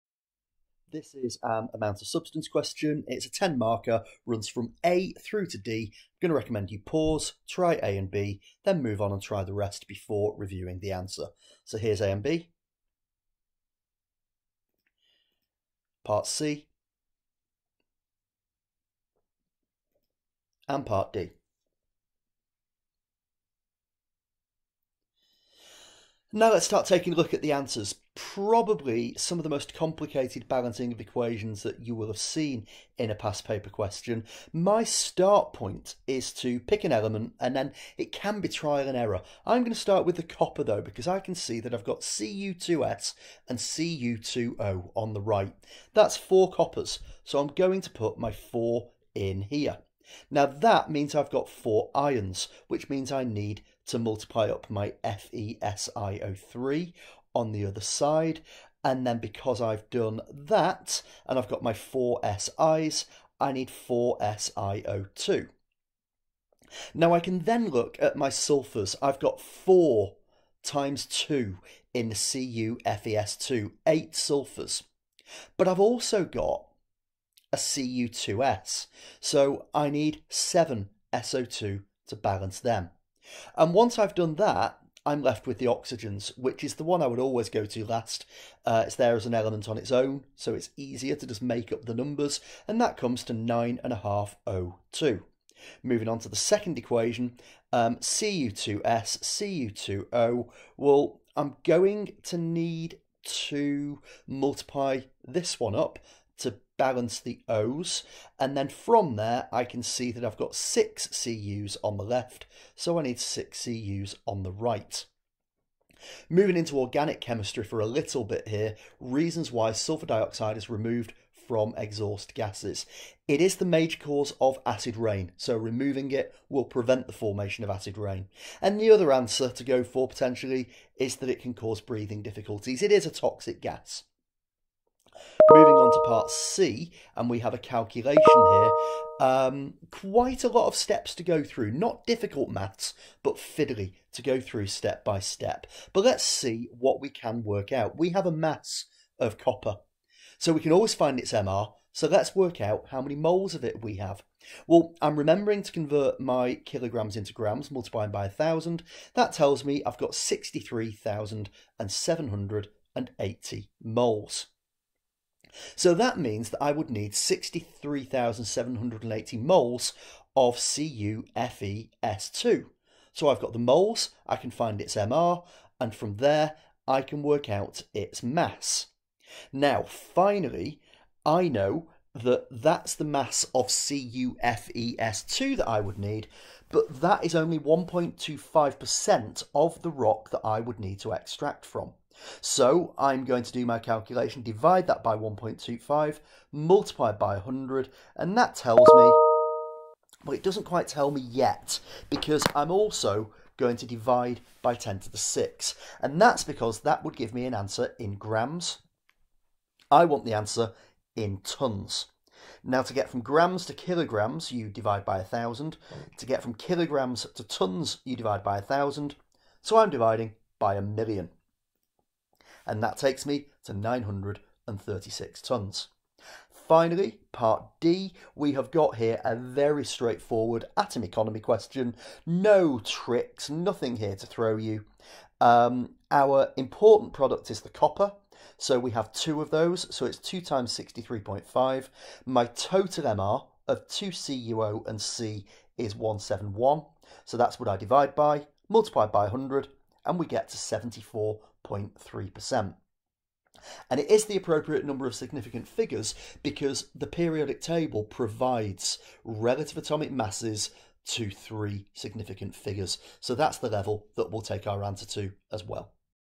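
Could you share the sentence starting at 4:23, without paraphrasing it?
So that's the level that we'll take our answer to as well.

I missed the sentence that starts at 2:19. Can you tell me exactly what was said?
Um, quite a lot of steps to go through, not difficult maths, but fiddly to go through step by step.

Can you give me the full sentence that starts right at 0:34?
My start point is to pick an element and then it can be trial and error.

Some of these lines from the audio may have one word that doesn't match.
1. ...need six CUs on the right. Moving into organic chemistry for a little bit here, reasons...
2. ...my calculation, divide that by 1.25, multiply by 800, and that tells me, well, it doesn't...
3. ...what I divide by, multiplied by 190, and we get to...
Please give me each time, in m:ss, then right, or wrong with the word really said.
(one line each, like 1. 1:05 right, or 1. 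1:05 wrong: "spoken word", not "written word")
1. 1:53 right
2. 3:13 wrong: "100", not "800"
3. 4:07 wrong: "100", not "190".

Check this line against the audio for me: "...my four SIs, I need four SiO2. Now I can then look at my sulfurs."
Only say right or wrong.
right.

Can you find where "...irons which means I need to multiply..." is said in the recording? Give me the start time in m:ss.
0:51.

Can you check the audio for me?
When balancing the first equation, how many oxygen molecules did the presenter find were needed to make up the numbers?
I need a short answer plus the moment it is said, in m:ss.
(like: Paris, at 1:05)
9.5, at 1:33.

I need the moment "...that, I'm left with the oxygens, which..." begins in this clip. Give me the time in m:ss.
1:24.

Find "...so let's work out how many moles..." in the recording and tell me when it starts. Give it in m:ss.
2:31.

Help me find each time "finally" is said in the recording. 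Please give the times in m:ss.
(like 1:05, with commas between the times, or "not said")
2:59, 3:46.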